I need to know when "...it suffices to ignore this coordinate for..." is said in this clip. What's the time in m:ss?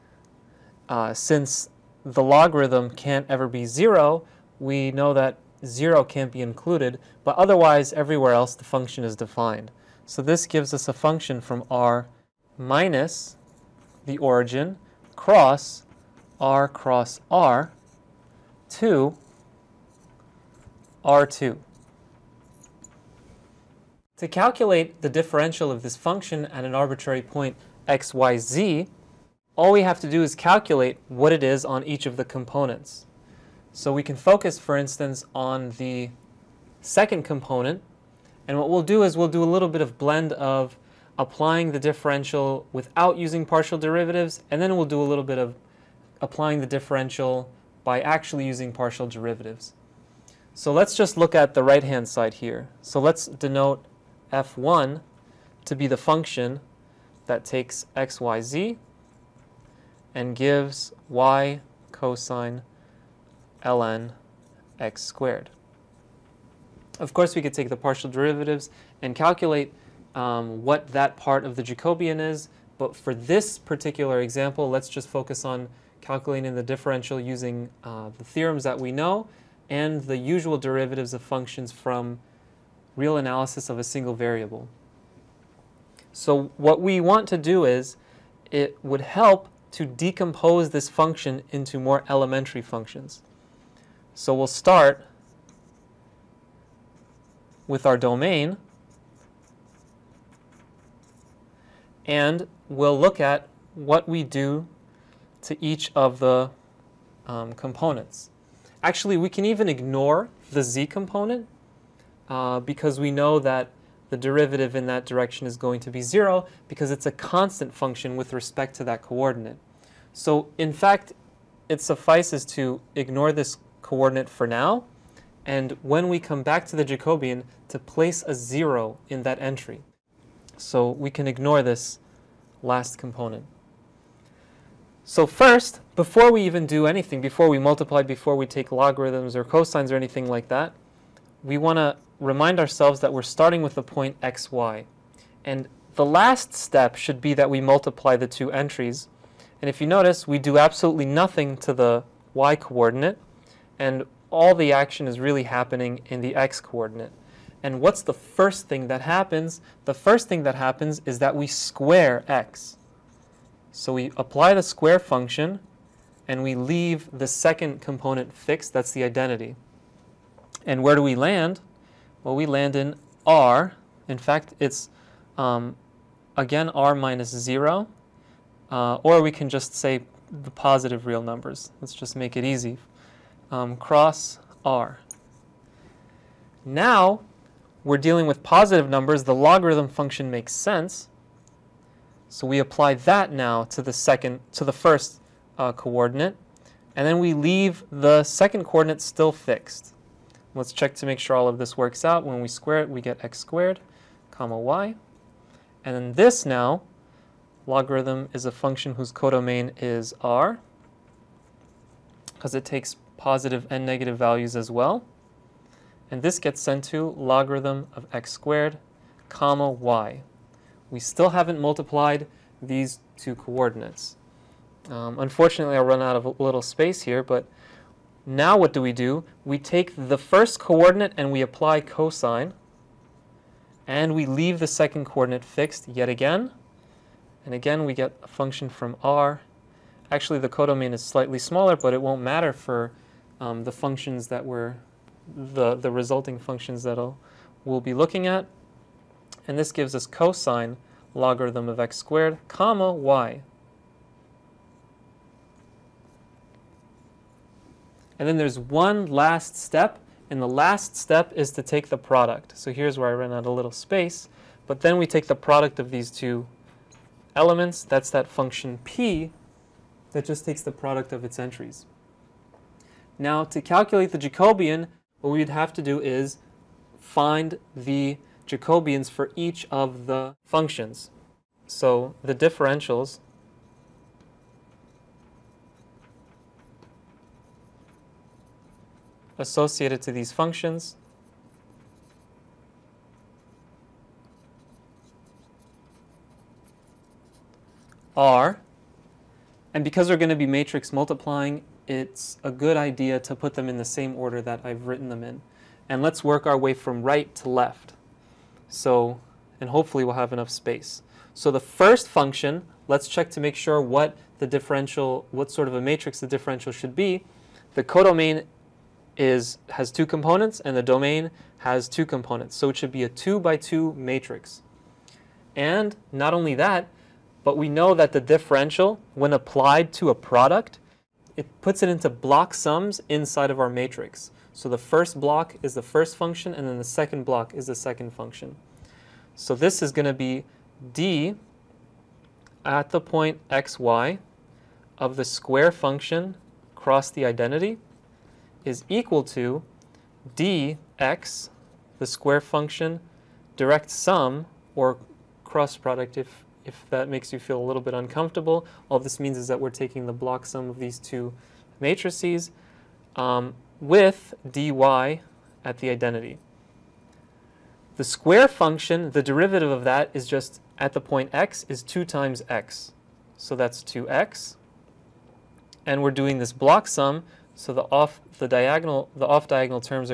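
2:01.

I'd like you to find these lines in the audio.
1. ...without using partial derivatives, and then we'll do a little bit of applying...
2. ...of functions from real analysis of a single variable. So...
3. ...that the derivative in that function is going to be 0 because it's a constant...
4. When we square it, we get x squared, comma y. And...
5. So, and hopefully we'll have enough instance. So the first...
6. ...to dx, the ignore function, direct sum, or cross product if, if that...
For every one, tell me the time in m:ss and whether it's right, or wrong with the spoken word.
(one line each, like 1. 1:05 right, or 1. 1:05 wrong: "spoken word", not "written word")
1. 0:42 right
2. 1:21 right
3. 1:53 wrong: "direction", not "function"
4. 3:22 right
5. 5:08 wrong: "space", not "instance"
6. 5:49 wrong: "square", not "ignore".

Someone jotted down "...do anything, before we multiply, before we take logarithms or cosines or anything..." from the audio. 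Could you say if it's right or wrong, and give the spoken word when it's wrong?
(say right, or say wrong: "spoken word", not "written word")
right.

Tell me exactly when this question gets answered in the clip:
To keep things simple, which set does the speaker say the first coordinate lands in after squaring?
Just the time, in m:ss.
3:00.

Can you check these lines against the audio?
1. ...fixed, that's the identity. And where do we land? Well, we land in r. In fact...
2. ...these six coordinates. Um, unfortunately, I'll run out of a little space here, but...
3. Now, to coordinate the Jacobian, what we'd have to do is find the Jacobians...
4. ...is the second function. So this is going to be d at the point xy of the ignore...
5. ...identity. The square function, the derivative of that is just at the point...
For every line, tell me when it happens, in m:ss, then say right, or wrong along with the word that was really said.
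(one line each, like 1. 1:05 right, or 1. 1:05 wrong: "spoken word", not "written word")
1. 2:48 right
2. 3:42 wrong: "two", not "six"
3. 4:33 wrong: "calculate", not "coordinate"
4. 5:37 wrong: "square", not "ignore"
5. 6:05 right.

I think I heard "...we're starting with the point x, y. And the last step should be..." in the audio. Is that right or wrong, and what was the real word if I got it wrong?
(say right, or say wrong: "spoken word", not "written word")
right.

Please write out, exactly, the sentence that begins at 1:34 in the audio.
So we'll start with our domain and we'll look at what we do to each of the um, components.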